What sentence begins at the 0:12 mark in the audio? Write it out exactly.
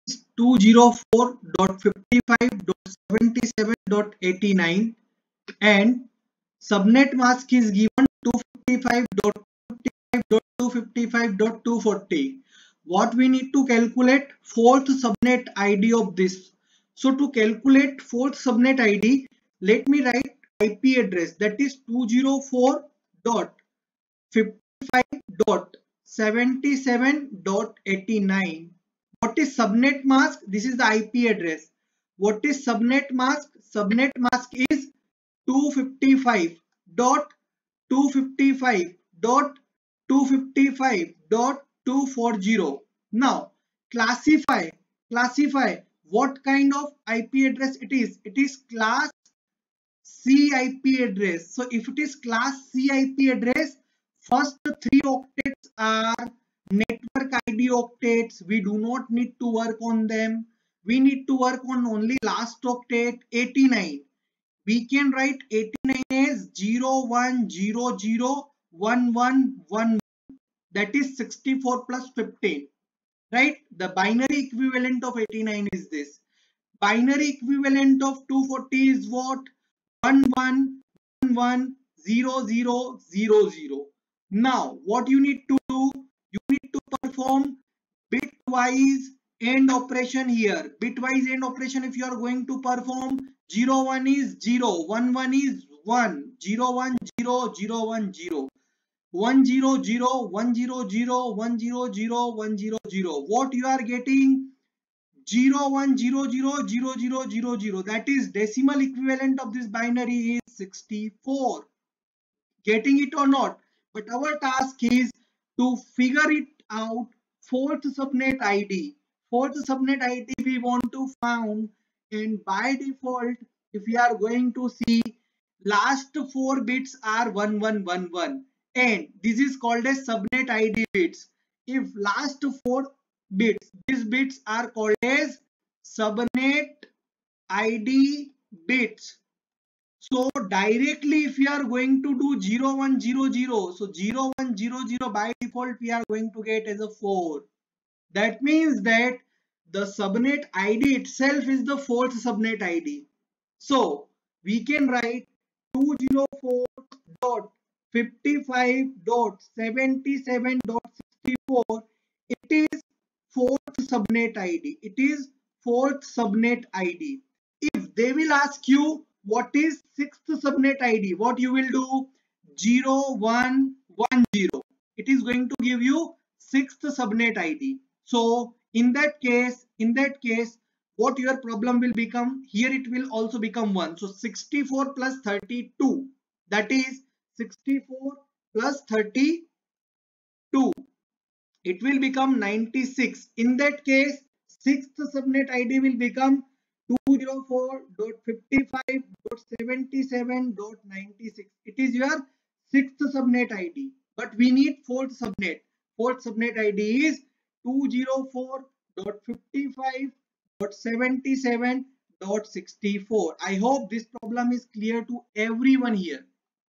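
What we need to calculate fourth subnet ID of this.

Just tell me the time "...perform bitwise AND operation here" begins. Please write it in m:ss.
1:26.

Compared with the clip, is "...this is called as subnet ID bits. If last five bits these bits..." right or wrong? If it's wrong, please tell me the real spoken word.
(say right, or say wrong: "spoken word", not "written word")
wrong: "four", not "five".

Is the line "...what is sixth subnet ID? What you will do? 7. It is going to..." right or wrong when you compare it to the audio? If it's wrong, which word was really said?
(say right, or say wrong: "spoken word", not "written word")
wrong: "0", not "7".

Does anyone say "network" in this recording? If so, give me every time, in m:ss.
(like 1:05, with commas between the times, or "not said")
0:56.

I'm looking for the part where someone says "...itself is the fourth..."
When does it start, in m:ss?
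2:30.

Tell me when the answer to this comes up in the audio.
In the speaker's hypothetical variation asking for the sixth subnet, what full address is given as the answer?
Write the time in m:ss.
3:16.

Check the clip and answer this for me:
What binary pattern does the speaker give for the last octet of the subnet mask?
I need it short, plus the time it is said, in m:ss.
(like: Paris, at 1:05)
11110000, at 1:20.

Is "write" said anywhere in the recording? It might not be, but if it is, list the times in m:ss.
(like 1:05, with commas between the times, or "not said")
0:20, 1:05, 2:34.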